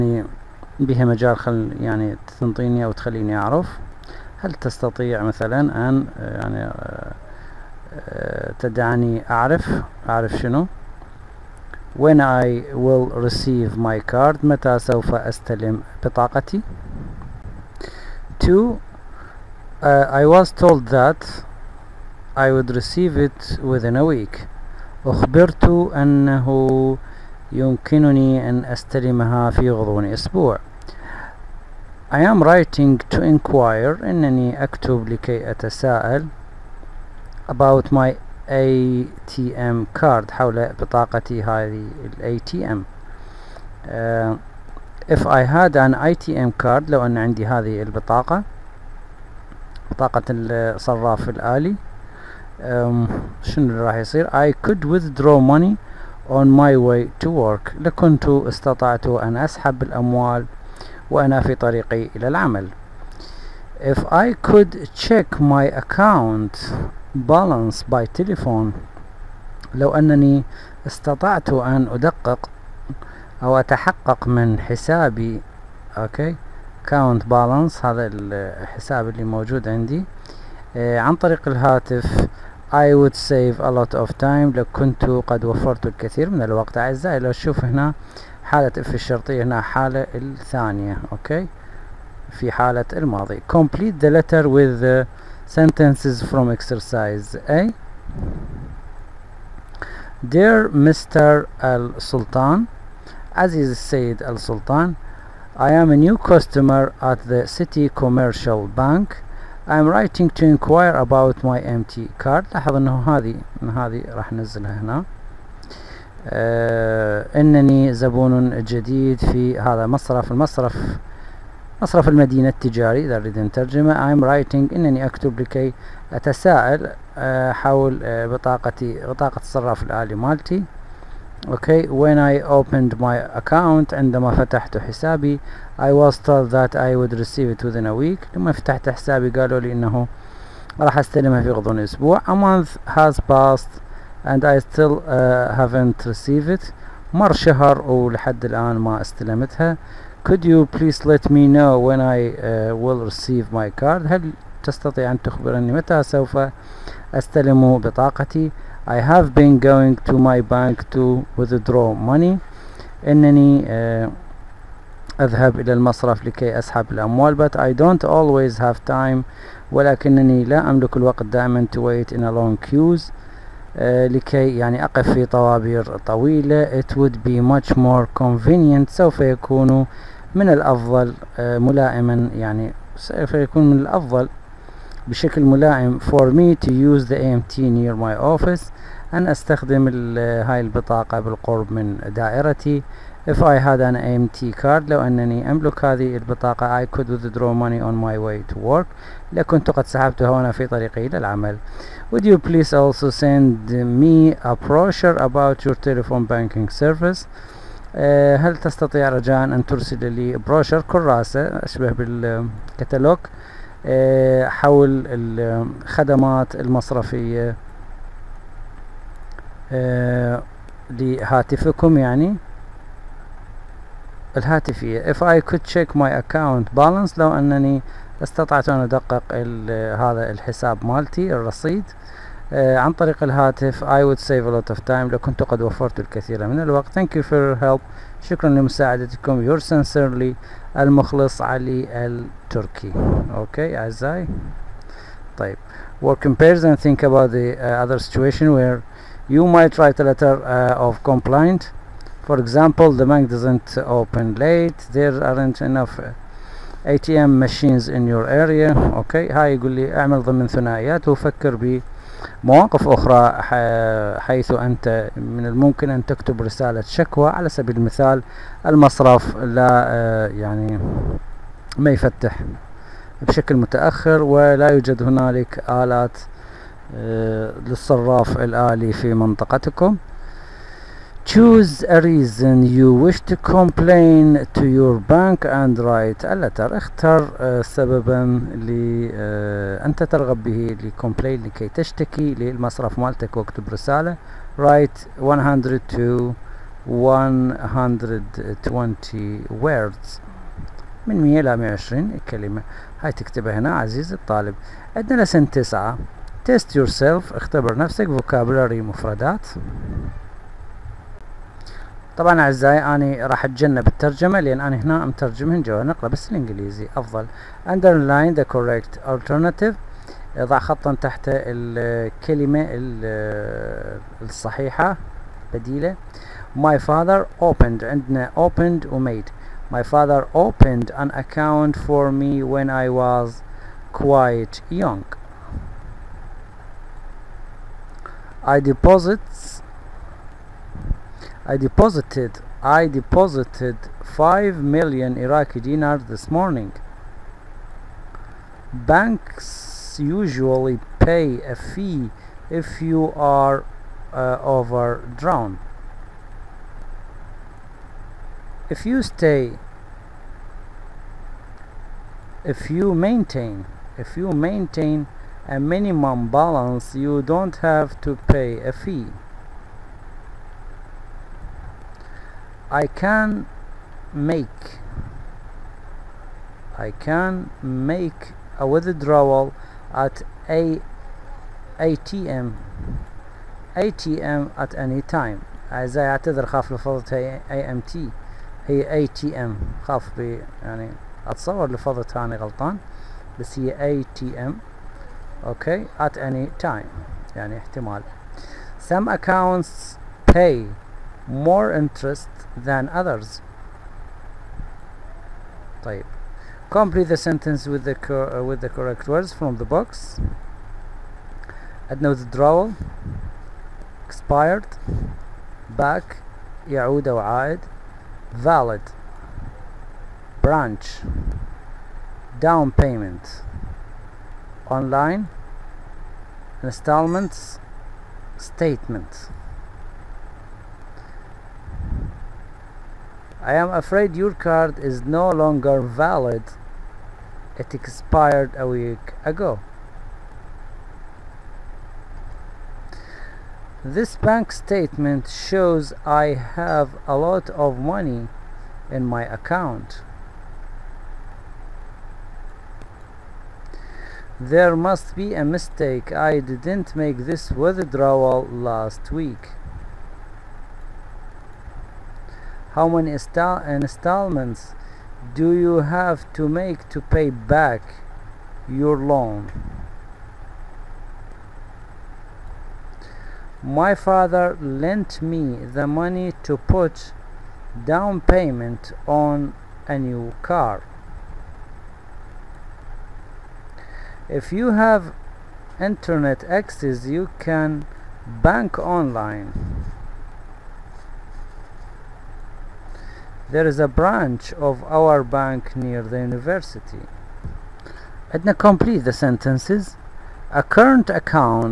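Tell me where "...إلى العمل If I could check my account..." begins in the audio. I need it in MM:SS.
01:02.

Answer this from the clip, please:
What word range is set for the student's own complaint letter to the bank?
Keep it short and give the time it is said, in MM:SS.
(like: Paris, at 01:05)
100 to 120 words, at 04:55.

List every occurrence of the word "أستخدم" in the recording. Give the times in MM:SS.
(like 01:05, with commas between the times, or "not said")
03:09.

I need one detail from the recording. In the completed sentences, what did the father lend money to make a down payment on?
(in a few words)
a new car.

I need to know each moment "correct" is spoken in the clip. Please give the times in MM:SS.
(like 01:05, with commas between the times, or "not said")
05:18, 06:48.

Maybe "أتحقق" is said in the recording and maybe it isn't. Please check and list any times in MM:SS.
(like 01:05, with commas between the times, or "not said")
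01:13.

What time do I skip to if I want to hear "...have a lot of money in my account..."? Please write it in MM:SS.
07:26.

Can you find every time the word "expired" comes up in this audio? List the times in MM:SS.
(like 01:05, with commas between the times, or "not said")
06:54, 07:17.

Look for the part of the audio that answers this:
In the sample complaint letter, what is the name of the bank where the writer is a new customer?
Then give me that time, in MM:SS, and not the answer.
01:47.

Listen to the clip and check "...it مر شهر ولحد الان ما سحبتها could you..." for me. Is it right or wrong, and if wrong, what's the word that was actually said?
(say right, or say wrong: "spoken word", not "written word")
wrong: "استلمتها", not "سحبتها".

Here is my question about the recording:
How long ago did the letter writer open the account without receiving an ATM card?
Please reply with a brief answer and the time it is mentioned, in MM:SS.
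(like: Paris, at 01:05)
a month, at 02:22.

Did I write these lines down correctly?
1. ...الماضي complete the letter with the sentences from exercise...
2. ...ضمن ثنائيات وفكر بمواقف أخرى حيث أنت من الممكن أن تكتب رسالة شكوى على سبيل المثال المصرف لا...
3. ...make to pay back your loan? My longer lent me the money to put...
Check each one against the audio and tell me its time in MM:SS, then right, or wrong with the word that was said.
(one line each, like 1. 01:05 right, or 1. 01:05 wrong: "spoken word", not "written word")
1. 01:32 right
2. 04:20 right
3. 07:46 wrong: "father", not "longer".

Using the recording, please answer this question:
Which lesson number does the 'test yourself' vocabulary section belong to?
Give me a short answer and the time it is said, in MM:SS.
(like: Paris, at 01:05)
9, at 05:05.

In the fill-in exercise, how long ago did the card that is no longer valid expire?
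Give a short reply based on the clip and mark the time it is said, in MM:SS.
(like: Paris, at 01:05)
a week ago, at 07:18.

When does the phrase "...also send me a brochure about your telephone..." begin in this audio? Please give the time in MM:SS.
03:22.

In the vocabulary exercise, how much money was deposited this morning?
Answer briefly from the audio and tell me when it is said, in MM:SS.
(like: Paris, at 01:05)
5 million Iraqi dinars, at 05:44.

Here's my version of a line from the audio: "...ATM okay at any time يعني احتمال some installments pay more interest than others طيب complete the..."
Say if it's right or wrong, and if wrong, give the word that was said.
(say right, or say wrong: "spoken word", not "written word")
wrong: "accounts", not "installments".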